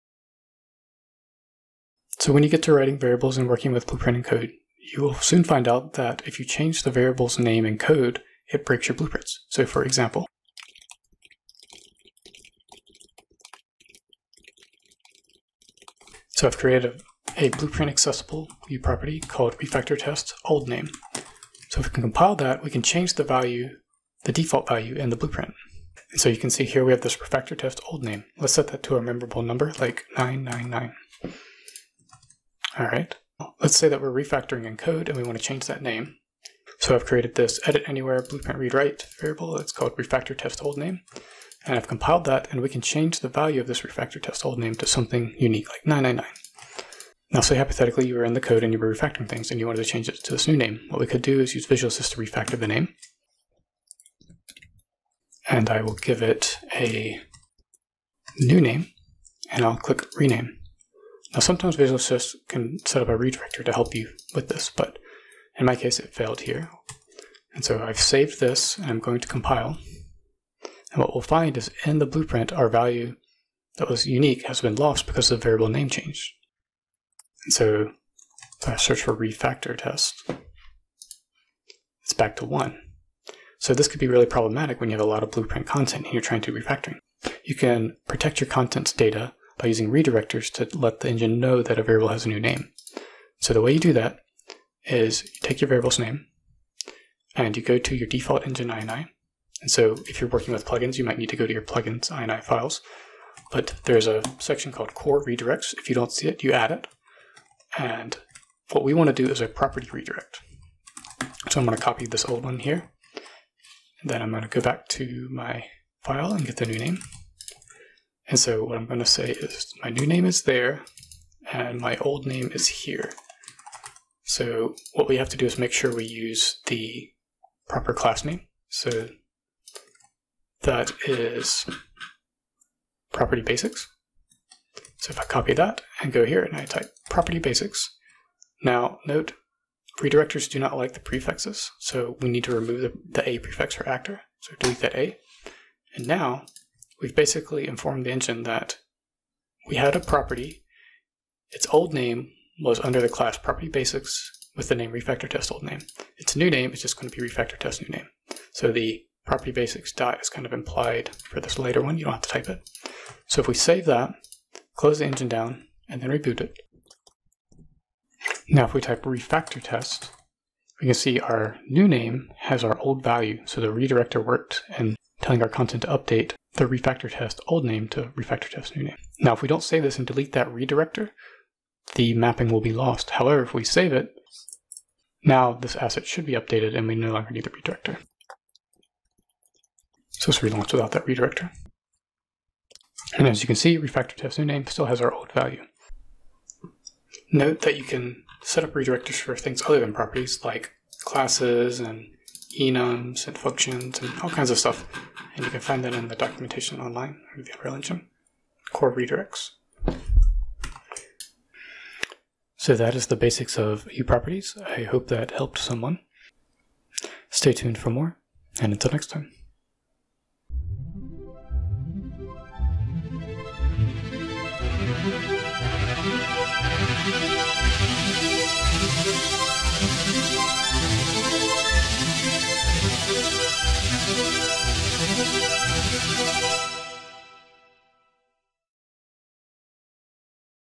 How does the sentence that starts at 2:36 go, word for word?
Its new name is just going to be refactor test new name.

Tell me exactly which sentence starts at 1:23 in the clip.
So this could be really problematic when you have a lot of blueprint content and you're trying to refactoring.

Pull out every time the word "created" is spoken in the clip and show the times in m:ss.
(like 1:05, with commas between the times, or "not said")
0:16, 0:37.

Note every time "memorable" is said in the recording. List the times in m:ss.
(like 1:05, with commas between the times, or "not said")
0:29.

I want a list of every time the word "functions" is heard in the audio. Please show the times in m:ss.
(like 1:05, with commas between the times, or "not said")
3:23.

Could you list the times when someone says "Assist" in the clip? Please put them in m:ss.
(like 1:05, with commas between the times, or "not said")
0:51, 1:01.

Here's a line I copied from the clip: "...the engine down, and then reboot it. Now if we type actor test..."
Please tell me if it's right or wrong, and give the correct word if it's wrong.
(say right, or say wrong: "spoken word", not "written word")
wrong: "refactor", not "actor".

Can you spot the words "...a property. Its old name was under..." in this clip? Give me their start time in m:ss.
2:29.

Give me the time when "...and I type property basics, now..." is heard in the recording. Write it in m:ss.
2:16.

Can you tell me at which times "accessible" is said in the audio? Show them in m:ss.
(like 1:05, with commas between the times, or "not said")
0:17.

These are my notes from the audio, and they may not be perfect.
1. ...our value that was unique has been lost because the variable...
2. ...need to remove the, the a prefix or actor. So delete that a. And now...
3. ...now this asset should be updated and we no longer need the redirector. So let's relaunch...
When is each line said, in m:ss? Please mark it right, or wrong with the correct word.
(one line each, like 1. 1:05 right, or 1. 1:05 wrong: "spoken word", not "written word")
1. 1:12 right
2. 2:22 right
3. 3:05 right.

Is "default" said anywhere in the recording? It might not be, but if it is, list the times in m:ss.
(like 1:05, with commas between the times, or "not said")
0:24, 1:38.